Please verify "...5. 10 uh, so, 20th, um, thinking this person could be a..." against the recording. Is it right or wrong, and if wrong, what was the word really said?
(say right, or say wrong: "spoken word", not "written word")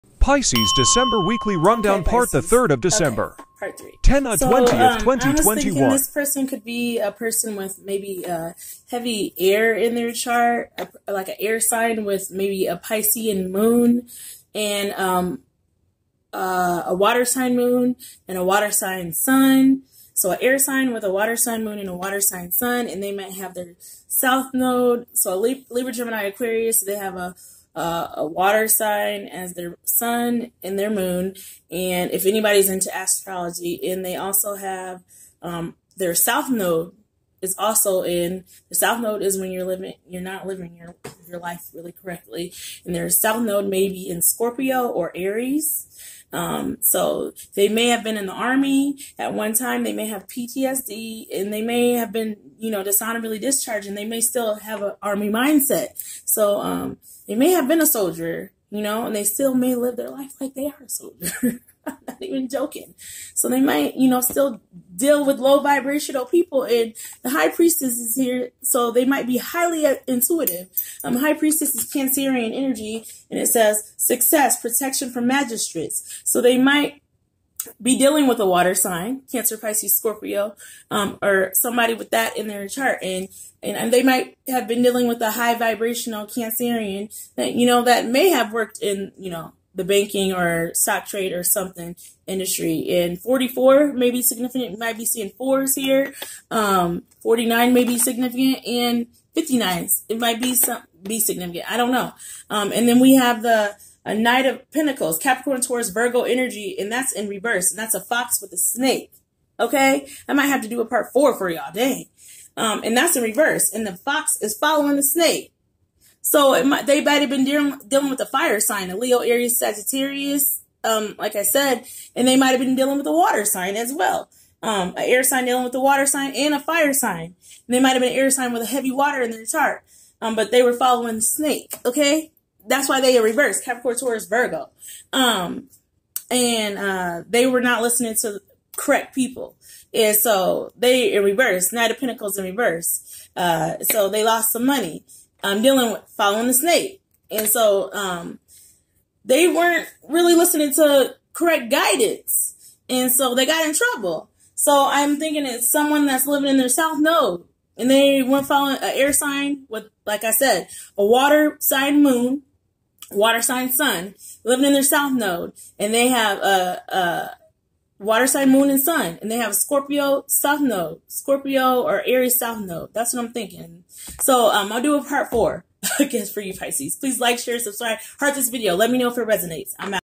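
wrong: "3", not "5".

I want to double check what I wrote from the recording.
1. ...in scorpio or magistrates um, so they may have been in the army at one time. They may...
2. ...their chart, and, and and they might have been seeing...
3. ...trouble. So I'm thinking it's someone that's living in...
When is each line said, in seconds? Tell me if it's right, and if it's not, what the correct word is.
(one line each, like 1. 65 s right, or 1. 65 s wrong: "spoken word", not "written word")
1. 44 s wrong: "aries", not "magistrates"
2. 82 s wrong: "dealing", not "seeing"
3. 153 s right.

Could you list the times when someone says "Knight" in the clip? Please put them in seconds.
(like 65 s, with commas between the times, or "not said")
104 s, 141 s.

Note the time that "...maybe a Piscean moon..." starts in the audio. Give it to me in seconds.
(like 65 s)
12 s.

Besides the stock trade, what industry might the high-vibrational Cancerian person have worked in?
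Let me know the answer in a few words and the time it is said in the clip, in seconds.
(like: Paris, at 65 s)
banking, at 89 s.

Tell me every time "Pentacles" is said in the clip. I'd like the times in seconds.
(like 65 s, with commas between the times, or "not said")
104 s, 141 s.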